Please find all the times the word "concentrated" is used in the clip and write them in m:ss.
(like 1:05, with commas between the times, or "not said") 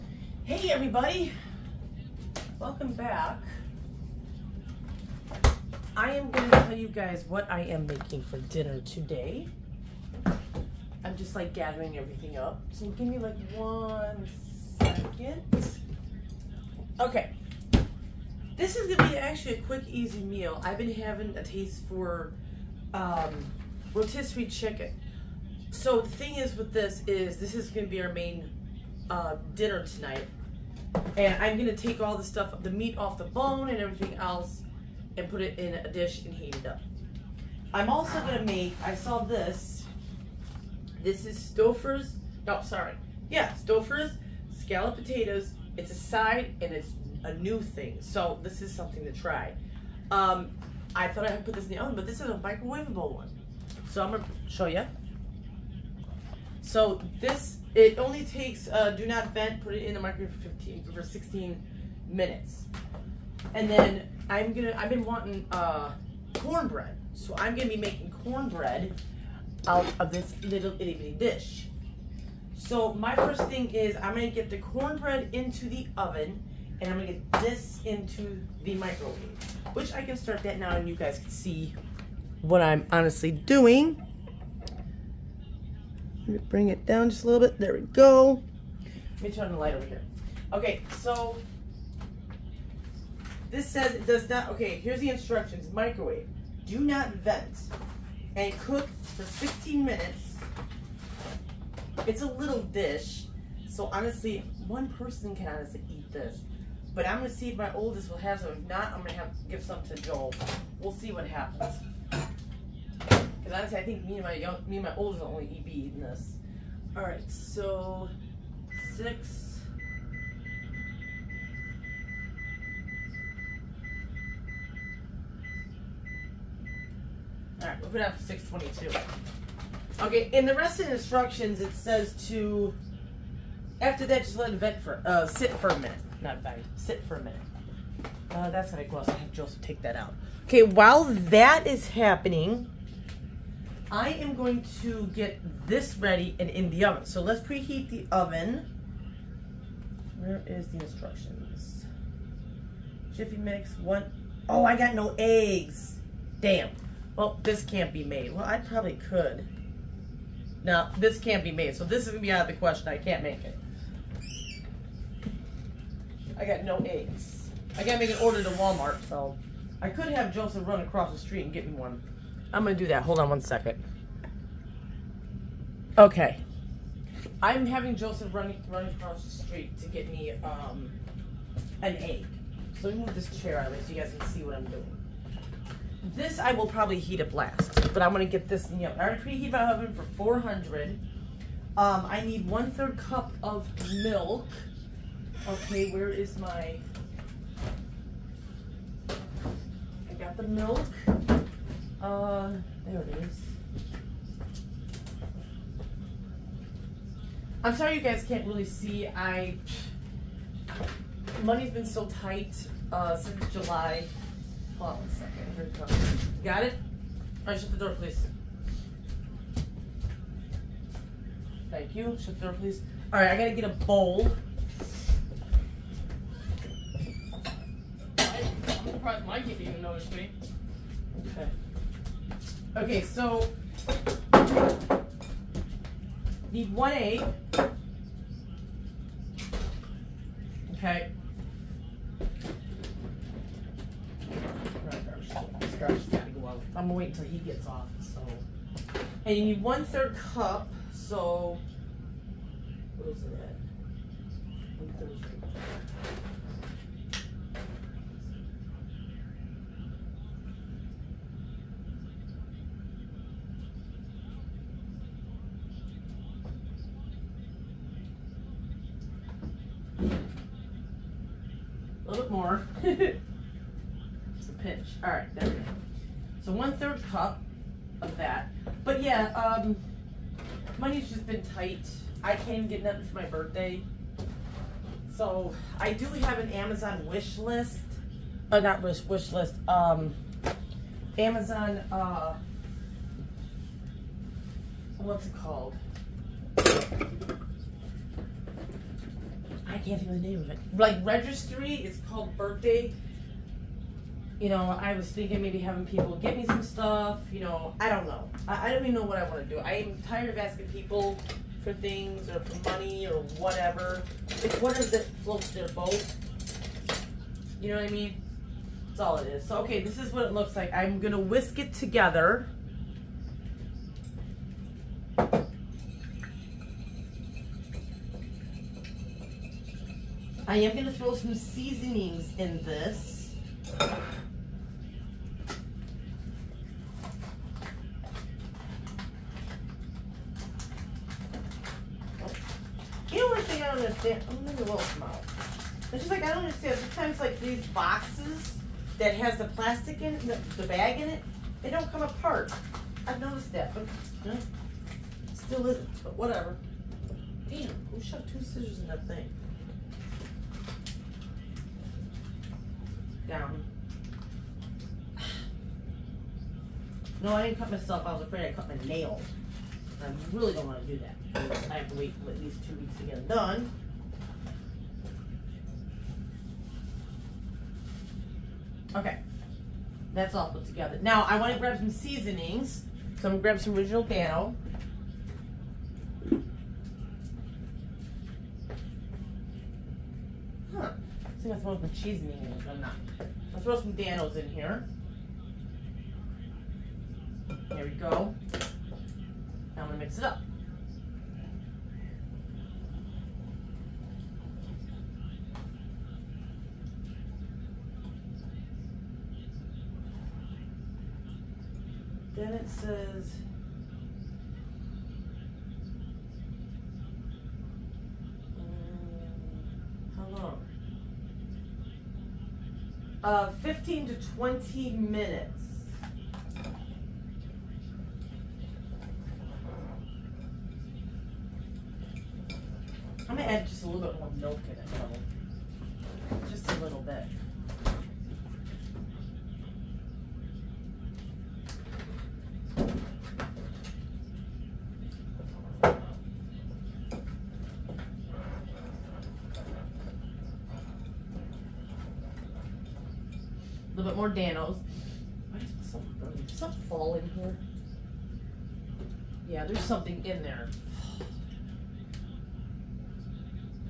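not said.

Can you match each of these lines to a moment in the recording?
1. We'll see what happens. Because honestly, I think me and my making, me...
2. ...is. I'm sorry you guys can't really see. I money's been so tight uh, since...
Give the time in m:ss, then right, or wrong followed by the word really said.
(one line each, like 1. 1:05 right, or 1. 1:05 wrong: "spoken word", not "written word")
1. 1:50 wrong: "young", not "making"
2. 3:23 right.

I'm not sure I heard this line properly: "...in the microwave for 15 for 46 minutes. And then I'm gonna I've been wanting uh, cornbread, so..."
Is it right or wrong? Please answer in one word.
wrong.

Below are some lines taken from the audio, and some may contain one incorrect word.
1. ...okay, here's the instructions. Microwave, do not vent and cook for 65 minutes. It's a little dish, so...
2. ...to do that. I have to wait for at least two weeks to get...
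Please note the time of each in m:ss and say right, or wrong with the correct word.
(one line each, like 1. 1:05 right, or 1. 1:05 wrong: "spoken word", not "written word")
1. 1:34 wrong: "15", not "65"
2. 6:10 right.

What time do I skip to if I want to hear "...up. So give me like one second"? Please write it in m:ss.
0:12.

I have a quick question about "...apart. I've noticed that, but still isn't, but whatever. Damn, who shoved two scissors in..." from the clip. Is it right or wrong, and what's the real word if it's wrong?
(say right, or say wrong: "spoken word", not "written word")
right.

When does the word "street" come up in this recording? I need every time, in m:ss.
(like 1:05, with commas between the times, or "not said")
2:51, 2:59.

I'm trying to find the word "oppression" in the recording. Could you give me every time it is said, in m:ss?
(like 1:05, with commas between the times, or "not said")
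not said.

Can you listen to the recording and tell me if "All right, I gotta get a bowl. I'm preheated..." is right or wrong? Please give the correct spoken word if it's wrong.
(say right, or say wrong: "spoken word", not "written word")
wrong: "surprised", not "preheated".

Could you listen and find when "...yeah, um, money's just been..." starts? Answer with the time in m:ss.
4:39.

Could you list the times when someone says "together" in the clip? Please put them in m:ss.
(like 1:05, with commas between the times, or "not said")
5:21, 6:20.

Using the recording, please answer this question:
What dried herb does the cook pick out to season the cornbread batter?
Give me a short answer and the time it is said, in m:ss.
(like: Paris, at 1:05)
oregano, at 6:23.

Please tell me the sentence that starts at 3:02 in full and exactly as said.
So let me move this chair out of so you guys can see what I'm doing.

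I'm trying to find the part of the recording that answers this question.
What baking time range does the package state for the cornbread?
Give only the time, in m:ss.
7:03.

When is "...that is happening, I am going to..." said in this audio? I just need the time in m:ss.
2:21.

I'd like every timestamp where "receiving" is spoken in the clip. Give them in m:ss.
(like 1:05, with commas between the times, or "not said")
not said.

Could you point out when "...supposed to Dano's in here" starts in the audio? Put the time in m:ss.
6:33.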